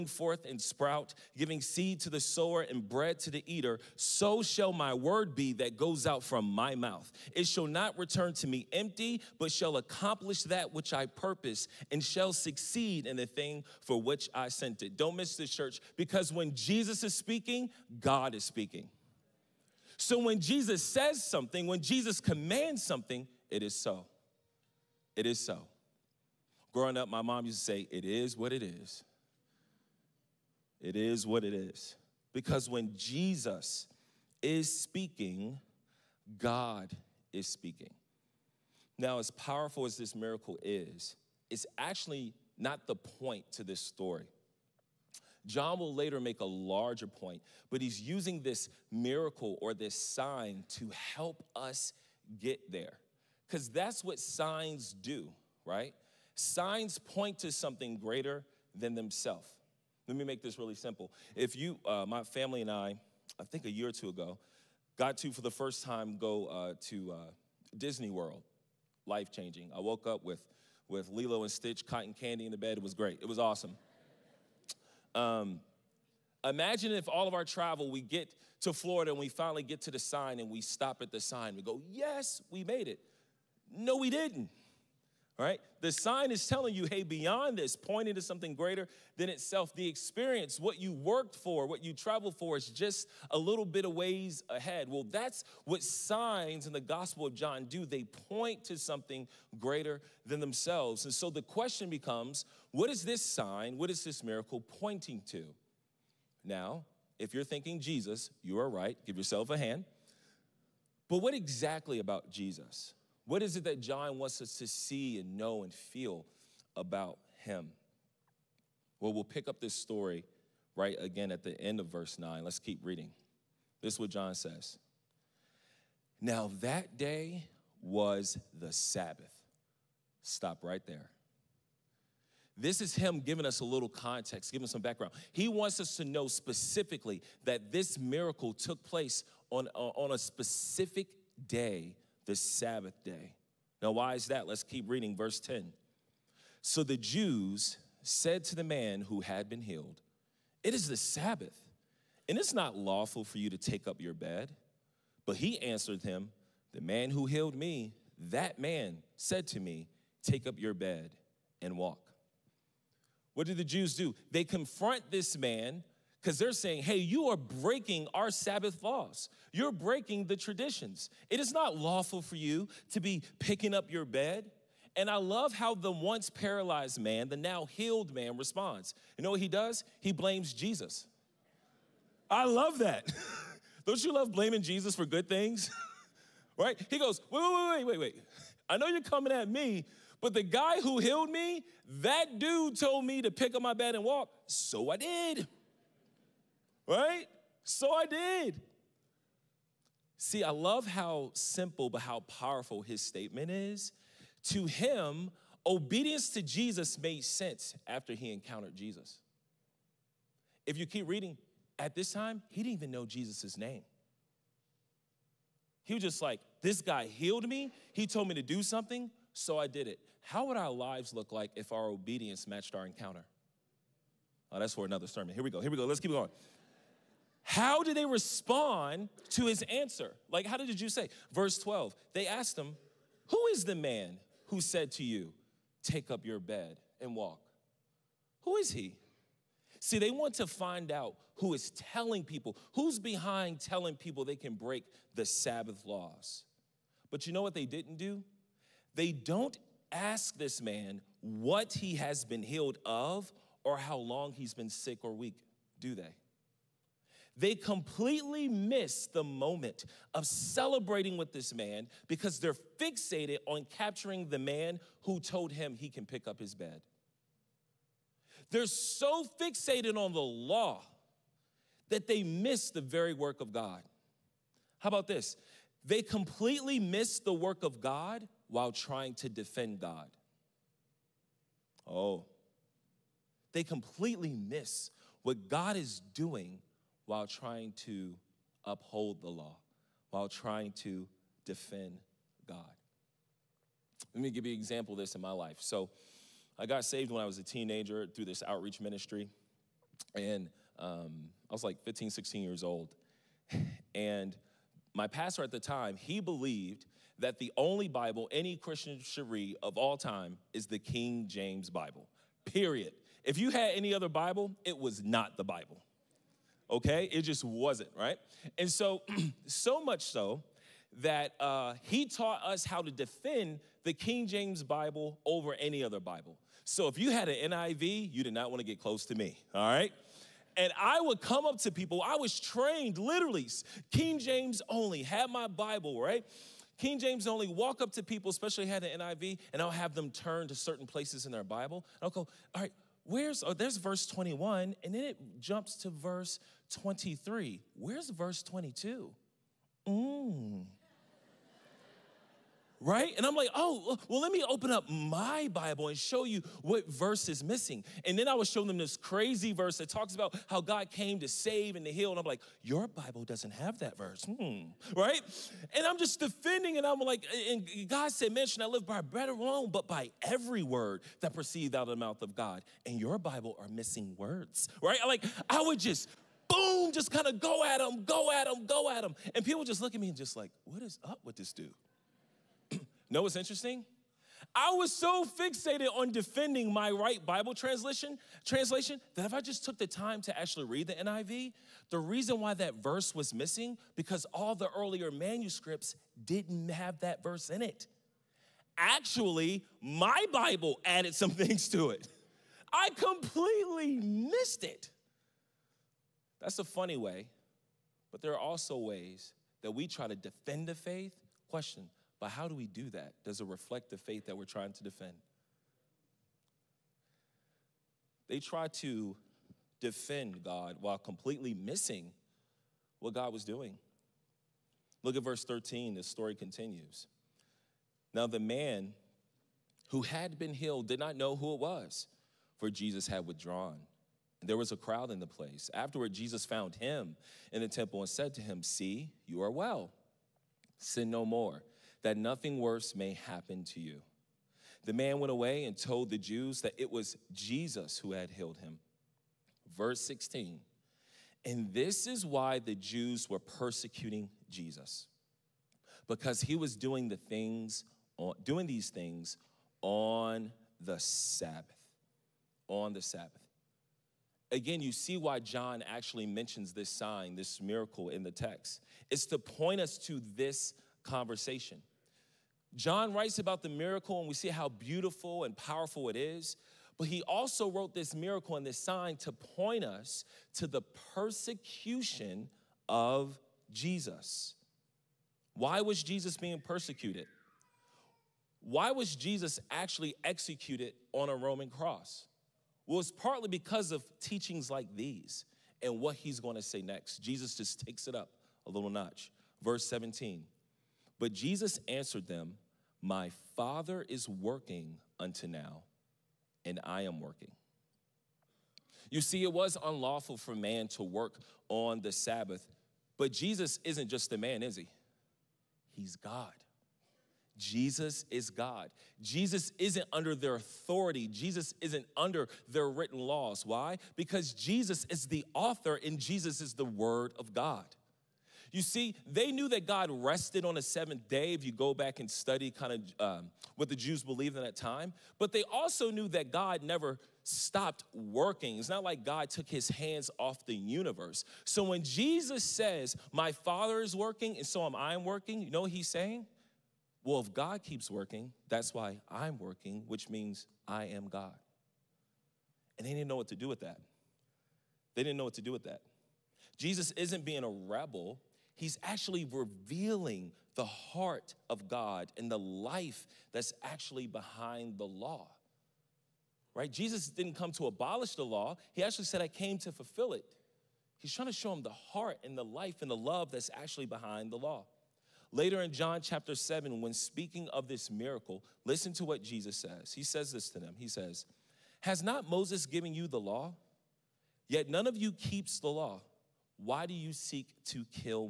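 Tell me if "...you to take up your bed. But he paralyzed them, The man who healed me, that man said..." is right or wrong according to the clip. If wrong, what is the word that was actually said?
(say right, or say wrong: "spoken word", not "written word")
wrong: "answered", not "paralyzed".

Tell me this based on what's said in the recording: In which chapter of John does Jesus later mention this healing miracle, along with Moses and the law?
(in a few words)
John chapter 7.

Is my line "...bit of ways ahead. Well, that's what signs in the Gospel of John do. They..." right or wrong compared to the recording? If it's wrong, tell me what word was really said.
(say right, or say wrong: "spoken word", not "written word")
right.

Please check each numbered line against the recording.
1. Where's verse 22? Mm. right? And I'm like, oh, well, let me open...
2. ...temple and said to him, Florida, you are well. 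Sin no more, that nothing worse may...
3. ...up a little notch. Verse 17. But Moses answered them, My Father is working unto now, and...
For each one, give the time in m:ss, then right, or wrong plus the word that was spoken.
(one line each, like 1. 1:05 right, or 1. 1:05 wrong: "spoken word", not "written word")
1. 5:47 right
2. 7:17 wrong: "See", not "Florida"
3. 8:18 wrong: "Jesus", not "Moses".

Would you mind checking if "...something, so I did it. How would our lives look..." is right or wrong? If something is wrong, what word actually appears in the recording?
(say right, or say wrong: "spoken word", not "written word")
right.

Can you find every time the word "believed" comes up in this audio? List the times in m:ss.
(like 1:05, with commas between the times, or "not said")
5:06, 8:54.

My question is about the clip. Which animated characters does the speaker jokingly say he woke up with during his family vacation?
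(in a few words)
Lilo and Stitch.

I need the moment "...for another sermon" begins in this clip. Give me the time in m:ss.
3:44.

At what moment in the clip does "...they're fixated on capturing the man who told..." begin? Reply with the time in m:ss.
4:22.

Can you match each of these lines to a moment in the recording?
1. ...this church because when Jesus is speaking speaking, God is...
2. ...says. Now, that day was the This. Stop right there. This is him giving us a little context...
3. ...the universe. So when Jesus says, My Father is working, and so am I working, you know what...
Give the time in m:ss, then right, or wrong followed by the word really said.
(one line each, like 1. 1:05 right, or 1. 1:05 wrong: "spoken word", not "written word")
1. 0:15 right
2. 2:04 wrong: "Sabbath", not "This"
3. 9:00 right.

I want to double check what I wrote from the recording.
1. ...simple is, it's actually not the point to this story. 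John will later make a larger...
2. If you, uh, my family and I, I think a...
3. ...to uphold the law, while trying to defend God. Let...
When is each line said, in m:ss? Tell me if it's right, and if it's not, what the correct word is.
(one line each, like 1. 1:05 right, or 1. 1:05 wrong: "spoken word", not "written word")
1. 0:40 wrong: "miracle", not "simple"
2. 1:01 right
3. 4:47 right.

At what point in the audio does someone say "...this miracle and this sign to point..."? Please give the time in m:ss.
7:57.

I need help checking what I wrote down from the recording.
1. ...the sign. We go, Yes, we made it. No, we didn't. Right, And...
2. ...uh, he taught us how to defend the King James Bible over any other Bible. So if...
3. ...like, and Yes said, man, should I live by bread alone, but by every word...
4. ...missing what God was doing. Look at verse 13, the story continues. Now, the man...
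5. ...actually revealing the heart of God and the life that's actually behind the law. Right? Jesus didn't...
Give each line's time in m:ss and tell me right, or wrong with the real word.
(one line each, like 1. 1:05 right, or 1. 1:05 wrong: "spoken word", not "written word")
1. 1:21 wrong: "The", not "And"
2. 5:21 right
3. 6:07 wrong: "God", not "Yes"
4. 7:01 right
5. 9:19 right.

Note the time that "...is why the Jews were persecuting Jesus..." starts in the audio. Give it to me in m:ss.
7:32.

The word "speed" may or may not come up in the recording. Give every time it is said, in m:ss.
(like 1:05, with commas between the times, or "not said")
not said.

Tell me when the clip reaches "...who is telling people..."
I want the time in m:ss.
4:01.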